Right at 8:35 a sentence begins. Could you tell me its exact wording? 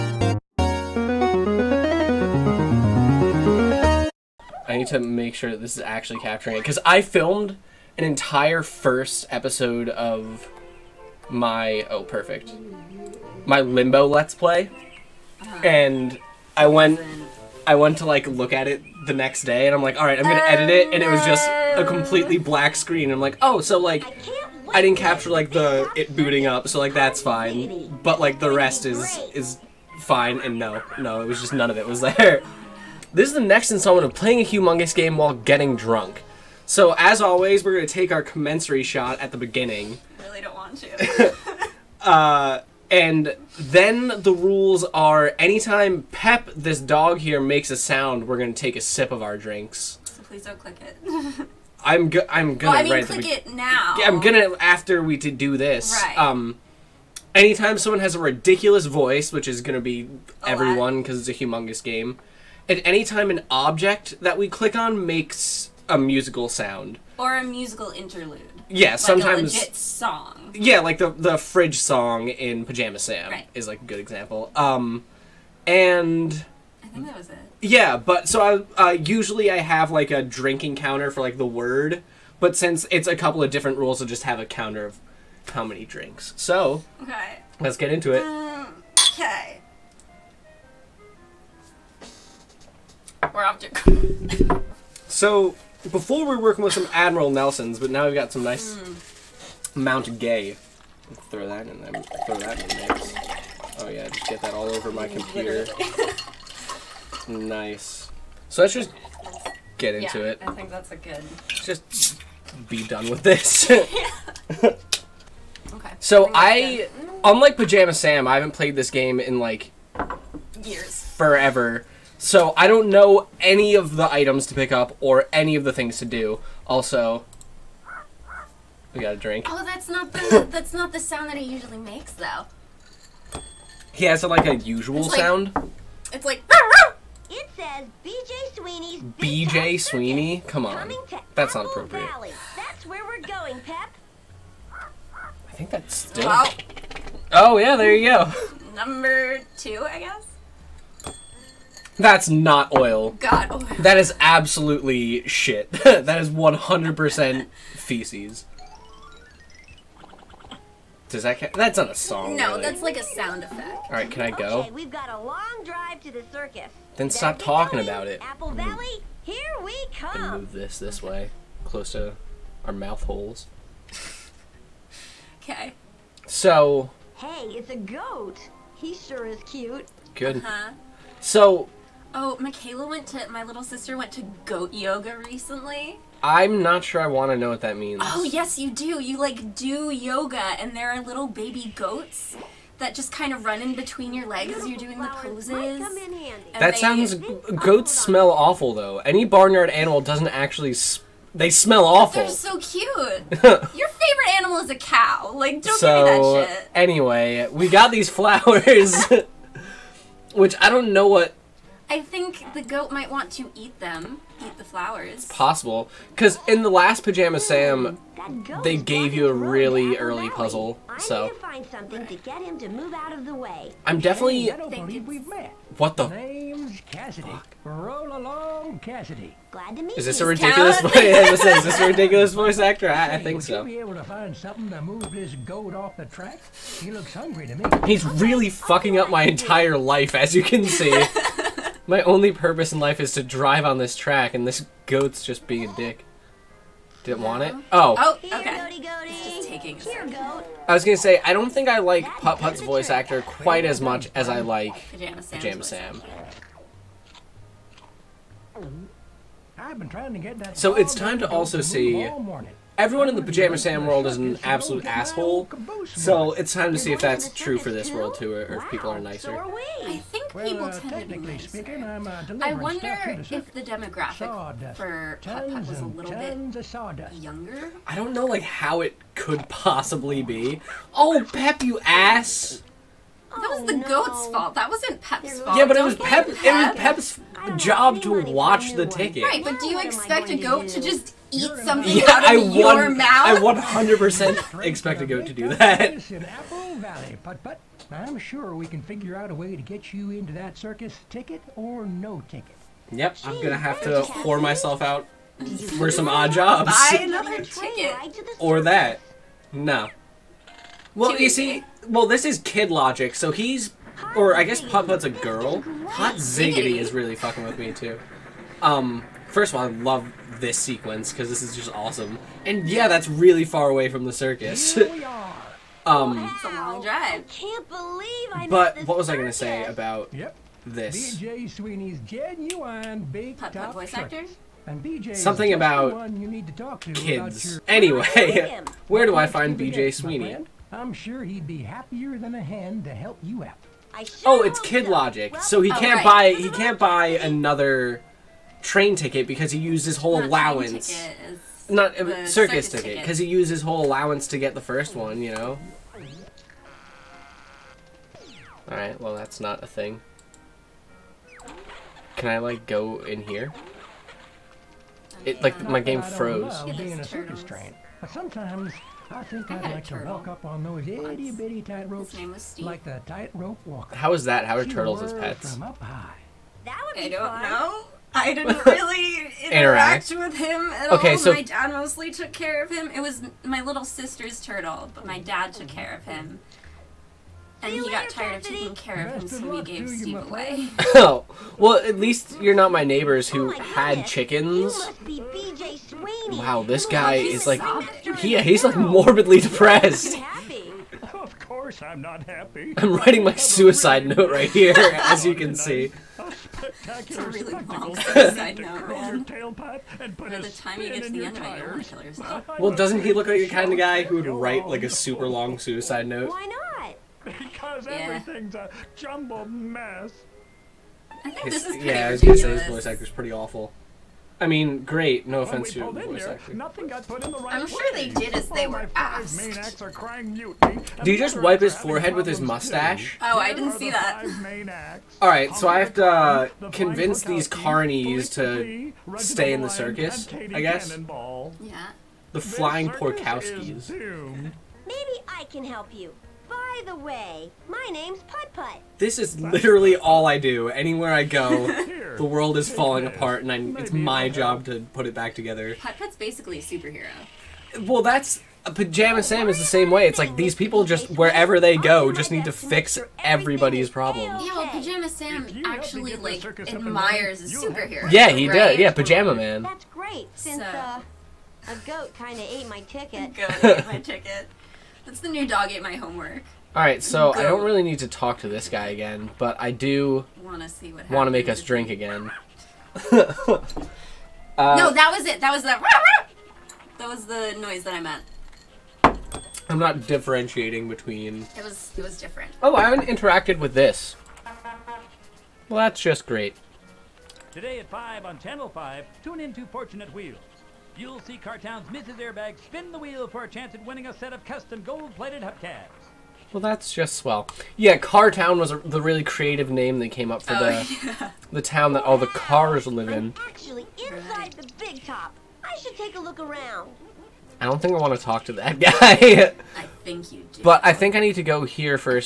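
I should take a look around.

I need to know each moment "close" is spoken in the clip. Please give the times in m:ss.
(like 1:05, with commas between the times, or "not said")
2:51.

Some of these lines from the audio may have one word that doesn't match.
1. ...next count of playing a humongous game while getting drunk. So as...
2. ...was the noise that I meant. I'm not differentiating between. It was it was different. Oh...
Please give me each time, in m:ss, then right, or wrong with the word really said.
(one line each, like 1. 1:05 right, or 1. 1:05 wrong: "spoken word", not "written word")
1. 0:33 wrong: "installment", not "count"
2. 8:07 right.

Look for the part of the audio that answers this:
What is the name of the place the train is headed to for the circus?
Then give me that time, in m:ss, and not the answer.
4:56.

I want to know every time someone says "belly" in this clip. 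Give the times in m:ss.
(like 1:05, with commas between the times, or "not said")
not said.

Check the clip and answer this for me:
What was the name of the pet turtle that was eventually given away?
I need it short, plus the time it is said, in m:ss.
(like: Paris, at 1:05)
Steve, at 6:29.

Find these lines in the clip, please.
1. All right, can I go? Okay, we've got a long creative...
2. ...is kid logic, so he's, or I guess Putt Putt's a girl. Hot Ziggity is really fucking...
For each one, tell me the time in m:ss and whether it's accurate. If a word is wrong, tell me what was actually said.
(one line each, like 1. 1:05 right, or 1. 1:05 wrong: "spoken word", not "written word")
1. 2:43 wrong: "drive", not "creative"
2. 5:12 right.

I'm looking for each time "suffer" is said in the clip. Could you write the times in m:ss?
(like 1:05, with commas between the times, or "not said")
not said.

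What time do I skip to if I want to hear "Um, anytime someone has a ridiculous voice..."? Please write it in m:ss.
0:56.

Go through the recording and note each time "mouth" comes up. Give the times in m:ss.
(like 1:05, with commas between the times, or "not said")
2:52, 4:52.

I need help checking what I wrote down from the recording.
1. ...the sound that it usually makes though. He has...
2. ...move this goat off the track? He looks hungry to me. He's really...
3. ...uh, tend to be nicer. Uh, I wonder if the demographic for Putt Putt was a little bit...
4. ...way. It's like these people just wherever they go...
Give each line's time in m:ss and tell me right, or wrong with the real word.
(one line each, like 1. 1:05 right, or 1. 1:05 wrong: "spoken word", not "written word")
1. 2:10 right
2. 3:54 right
3. 4:30 right
4. 7:39 right.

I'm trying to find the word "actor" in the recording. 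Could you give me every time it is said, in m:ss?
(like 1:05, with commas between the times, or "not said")
3:52, 4:12, 5:33, 7:02.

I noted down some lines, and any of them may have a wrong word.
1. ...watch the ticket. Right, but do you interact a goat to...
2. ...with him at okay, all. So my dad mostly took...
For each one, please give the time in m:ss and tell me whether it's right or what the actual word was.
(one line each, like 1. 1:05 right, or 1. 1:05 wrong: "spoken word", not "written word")
1. 4:48 wrong: "expect", not "interact"
2. 6:20 right.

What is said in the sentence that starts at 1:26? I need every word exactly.
So okay, let's get into it.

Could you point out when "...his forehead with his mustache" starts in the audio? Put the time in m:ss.
7:11.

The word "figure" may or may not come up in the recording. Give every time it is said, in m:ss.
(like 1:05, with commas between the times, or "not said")
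4:58.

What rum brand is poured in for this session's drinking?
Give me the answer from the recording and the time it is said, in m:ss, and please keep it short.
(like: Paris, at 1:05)
Mount Gay, at 1:39.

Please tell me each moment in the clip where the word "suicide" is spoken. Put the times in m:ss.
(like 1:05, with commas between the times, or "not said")
6:43, 6:55.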